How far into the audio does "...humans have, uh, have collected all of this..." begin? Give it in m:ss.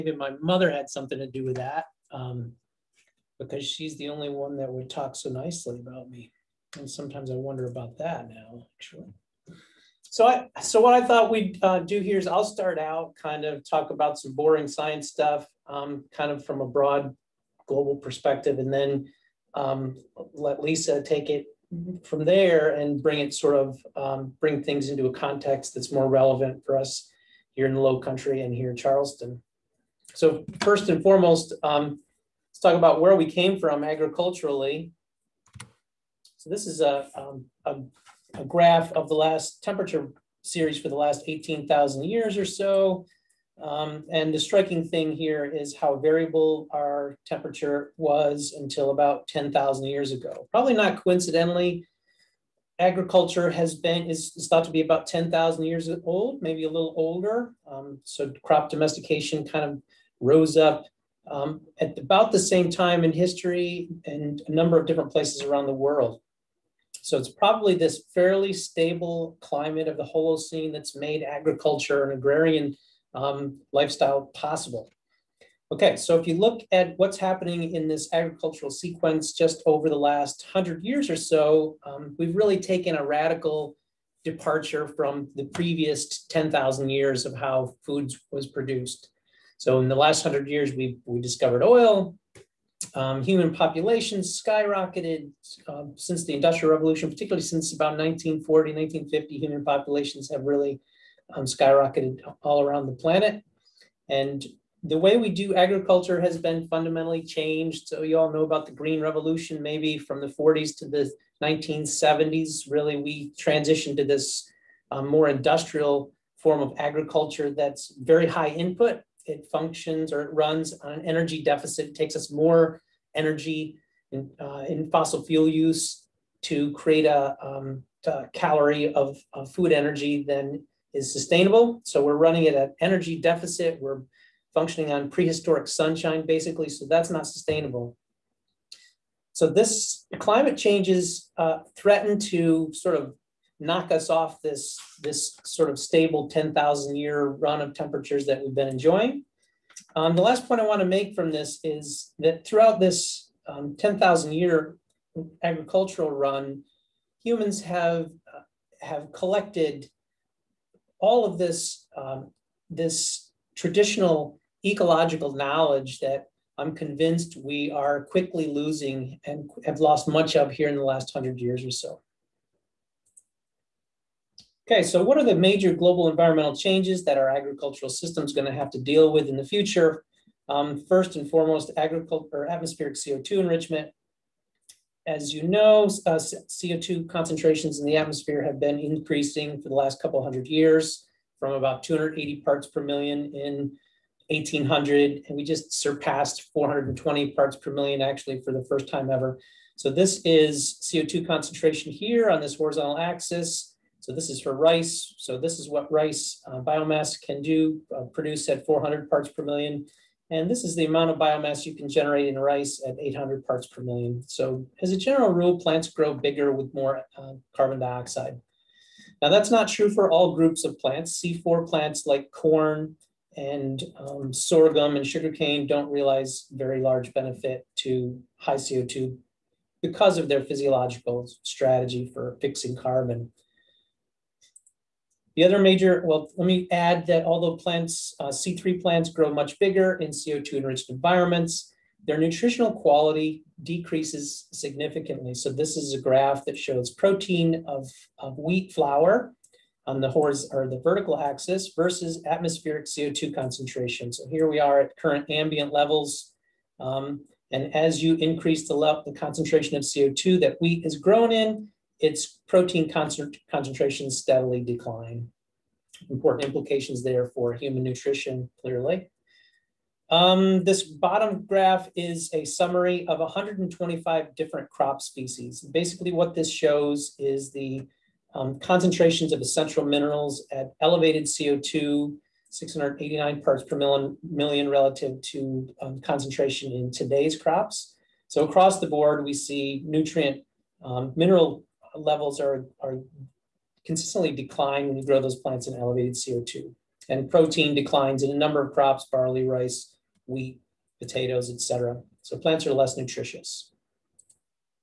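2:37.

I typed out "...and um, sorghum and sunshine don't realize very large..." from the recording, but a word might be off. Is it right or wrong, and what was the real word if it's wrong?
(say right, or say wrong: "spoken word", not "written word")
wrong: "sugarcane", not "sunshine".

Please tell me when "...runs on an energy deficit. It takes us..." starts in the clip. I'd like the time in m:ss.
2:00.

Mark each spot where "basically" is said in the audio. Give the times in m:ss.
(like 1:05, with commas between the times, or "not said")
2:16, 4:35.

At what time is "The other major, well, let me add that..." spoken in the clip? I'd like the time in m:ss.
3:55.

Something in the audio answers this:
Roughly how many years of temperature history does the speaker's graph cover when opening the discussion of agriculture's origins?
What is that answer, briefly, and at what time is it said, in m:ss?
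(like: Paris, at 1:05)
18,000 years, at 0:41.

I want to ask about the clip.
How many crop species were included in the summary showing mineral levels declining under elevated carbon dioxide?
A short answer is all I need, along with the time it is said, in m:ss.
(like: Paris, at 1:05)
125, at 4:33.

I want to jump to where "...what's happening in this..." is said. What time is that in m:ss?
1:16.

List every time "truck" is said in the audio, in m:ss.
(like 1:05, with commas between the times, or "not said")
not said.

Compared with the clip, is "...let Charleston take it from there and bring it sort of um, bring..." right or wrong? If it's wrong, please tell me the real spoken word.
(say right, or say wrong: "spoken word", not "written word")
wrong: "Lisa", not "Charleston".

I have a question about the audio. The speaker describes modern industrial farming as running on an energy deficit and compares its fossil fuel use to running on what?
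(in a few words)
prehistoric sunshine.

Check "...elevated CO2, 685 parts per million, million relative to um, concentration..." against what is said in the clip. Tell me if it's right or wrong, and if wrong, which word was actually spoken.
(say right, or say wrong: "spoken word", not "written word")
wrong: "689", not "685".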